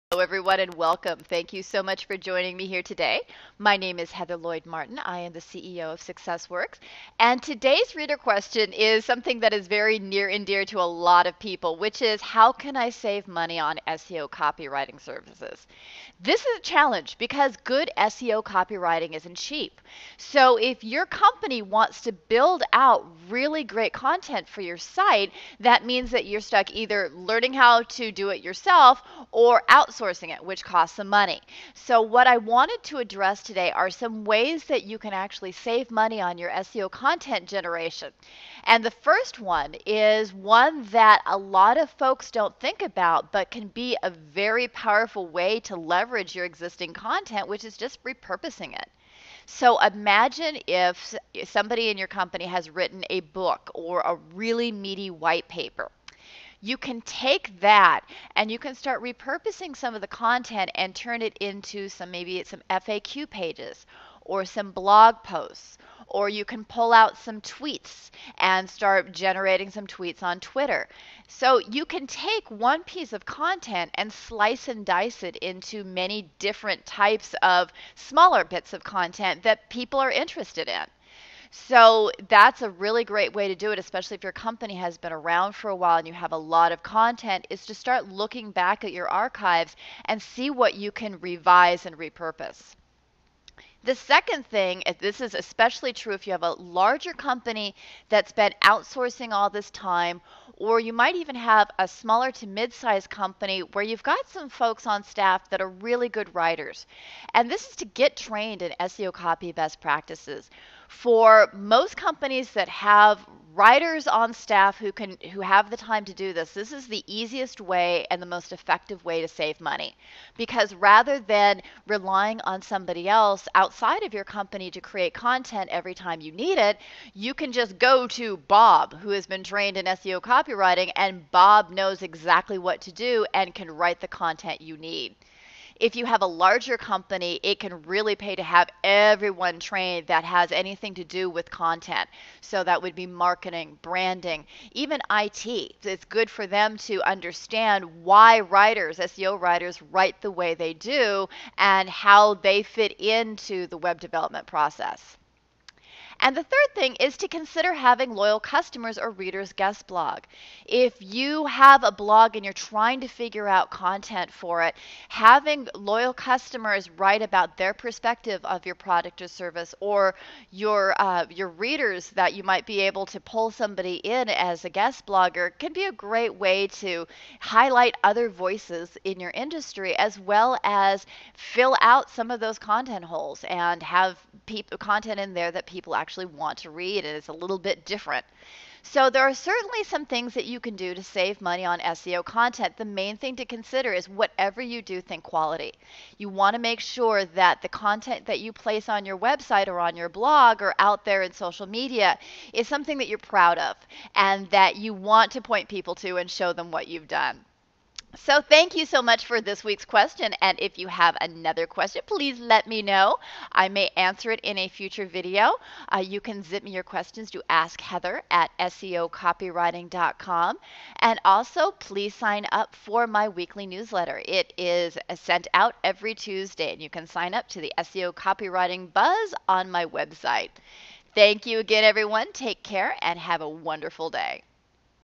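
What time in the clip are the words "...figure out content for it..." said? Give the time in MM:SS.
02:43.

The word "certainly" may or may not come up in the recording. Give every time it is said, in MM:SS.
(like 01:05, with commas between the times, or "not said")
03:09.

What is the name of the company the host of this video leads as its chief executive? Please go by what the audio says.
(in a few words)
SuccessWorks.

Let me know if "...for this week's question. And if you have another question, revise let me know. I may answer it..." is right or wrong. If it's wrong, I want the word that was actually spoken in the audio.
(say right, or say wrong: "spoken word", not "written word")
wrong: "please", not "revise".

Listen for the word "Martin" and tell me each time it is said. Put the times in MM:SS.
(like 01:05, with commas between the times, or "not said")
00:04.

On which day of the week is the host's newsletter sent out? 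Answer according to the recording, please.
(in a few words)
Tuesday.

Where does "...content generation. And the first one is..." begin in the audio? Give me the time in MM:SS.
00:36.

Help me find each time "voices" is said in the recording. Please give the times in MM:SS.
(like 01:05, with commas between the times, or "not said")
02:58.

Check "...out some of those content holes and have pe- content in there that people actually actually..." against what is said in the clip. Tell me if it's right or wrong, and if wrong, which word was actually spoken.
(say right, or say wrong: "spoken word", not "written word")
right.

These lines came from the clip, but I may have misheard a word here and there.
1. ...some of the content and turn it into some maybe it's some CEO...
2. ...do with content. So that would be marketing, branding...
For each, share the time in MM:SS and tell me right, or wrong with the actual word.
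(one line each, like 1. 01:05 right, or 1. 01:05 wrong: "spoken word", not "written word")
1. 00:59 wrong: "FAQ", not "CEO"
2. 02:21 right.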